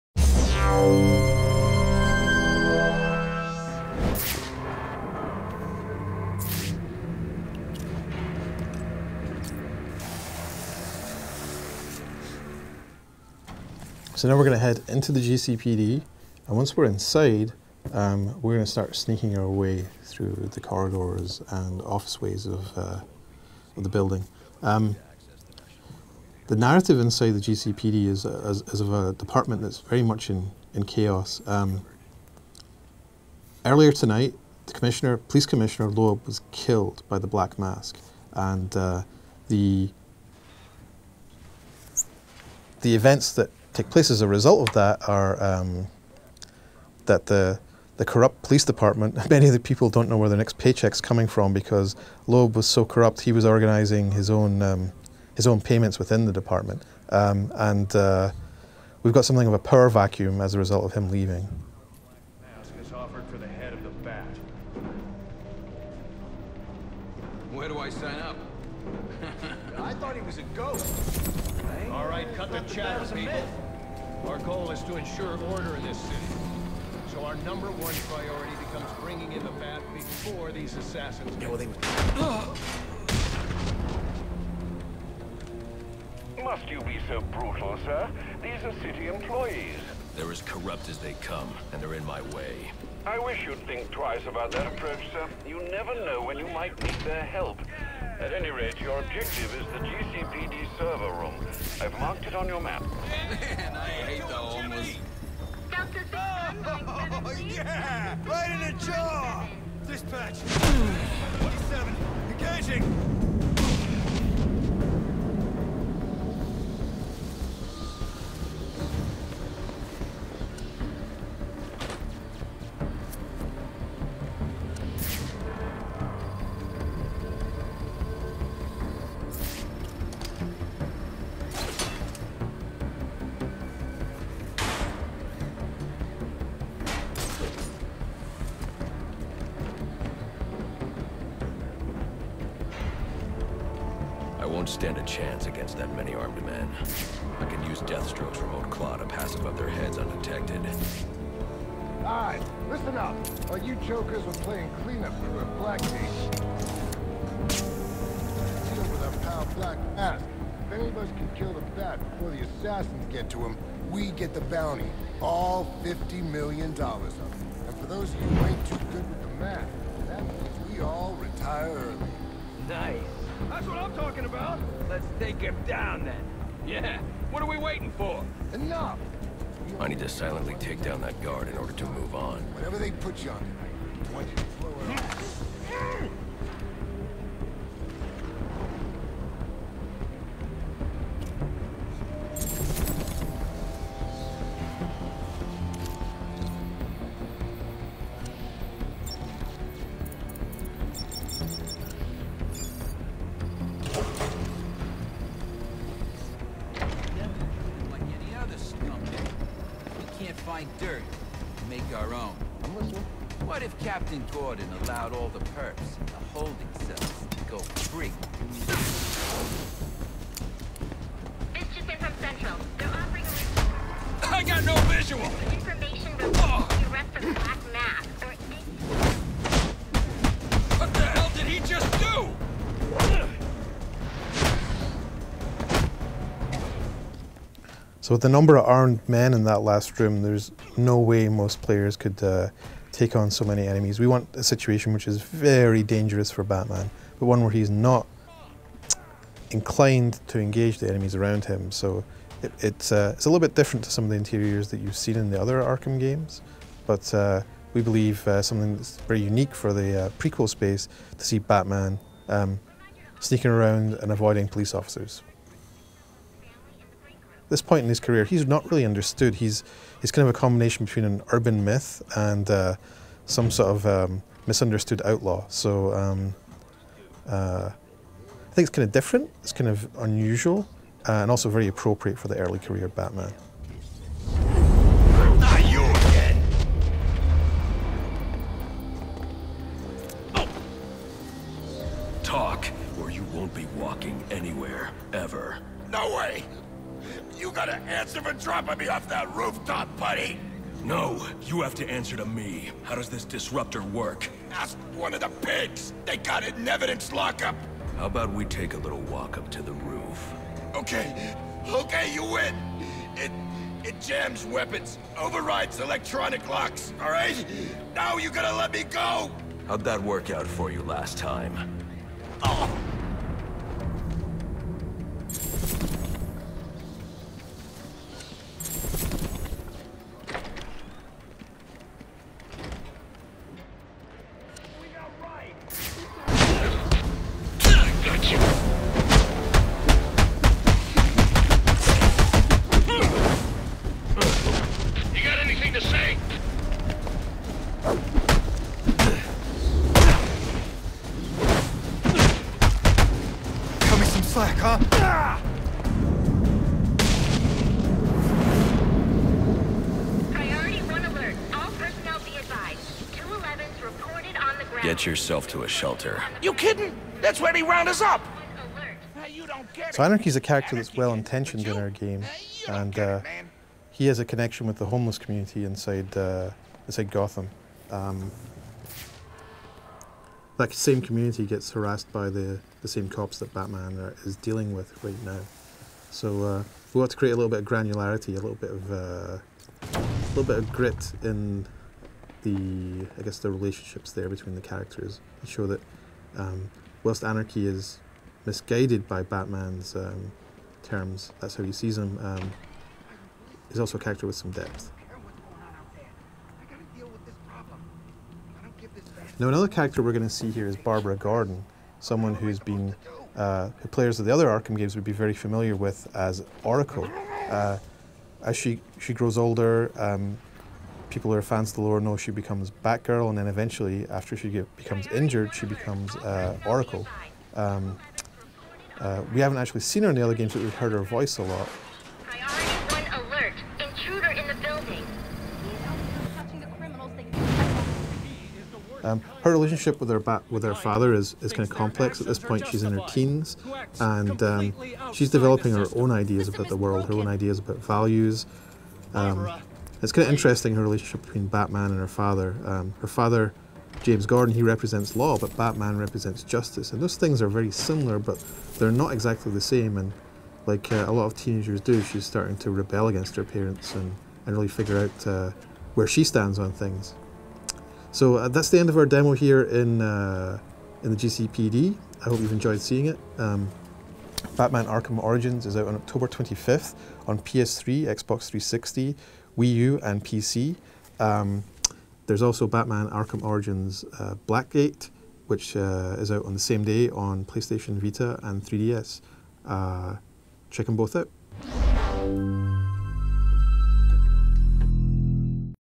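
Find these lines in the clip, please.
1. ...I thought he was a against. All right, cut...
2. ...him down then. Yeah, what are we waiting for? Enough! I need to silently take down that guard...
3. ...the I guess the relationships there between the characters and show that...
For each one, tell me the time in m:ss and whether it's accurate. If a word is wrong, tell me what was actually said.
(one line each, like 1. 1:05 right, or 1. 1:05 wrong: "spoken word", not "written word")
1. 1:09 wrong: "ghost", not "against"
2. 2:55 right
3. 6:32 right.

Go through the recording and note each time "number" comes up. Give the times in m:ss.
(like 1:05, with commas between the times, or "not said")
1:17, 3:58.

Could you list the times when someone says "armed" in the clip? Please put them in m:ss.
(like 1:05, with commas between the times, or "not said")
2:26, 3:58.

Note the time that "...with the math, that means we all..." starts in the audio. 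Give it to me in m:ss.
2:49.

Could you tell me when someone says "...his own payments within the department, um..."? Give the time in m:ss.
0:55.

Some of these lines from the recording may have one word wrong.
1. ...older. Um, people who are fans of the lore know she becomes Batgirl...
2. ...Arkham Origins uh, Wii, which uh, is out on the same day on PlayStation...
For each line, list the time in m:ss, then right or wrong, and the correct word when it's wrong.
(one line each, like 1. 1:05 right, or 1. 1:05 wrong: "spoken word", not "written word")
1. 6:59 right
2. 8:03 wrong: "Blackgate", not "Wii".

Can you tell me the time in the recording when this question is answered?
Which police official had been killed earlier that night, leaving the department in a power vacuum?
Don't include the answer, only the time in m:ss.
0:35.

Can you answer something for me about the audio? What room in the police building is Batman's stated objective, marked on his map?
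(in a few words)
GCPD server room.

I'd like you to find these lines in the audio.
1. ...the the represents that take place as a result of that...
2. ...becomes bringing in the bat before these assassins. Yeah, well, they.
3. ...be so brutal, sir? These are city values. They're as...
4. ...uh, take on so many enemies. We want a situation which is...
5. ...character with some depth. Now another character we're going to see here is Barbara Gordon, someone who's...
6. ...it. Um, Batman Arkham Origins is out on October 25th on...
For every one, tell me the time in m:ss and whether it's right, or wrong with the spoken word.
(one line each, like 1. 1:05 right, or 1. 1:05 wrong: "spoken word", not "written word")
1. 0:39 wrong: "events", not "represents"
2. 1:18 right
3. 1:26 wrong: "employees", not "values"
4. 4:02 right
5. 6:44 right
6. 7:53 right.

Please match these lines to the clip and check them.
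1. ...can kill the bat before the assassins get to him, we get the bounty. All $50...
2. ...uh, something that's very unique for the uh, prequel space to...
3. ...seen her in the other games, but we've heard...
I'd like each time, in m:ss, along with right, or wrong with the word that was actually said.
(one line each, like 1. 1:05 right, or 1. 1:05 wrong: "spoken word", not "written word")
1. 2:41 right
2. 4:18 right
3. 7:09 right.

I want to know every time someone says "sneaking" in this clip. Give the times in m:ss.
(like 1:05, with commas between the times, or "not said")
0:18, 4:23.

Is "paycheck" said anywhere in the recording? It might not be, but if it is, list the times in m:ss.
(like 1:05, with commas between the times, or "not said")
0:50.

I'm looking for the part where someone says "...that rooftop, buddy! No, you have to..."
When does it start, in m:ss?
4:59.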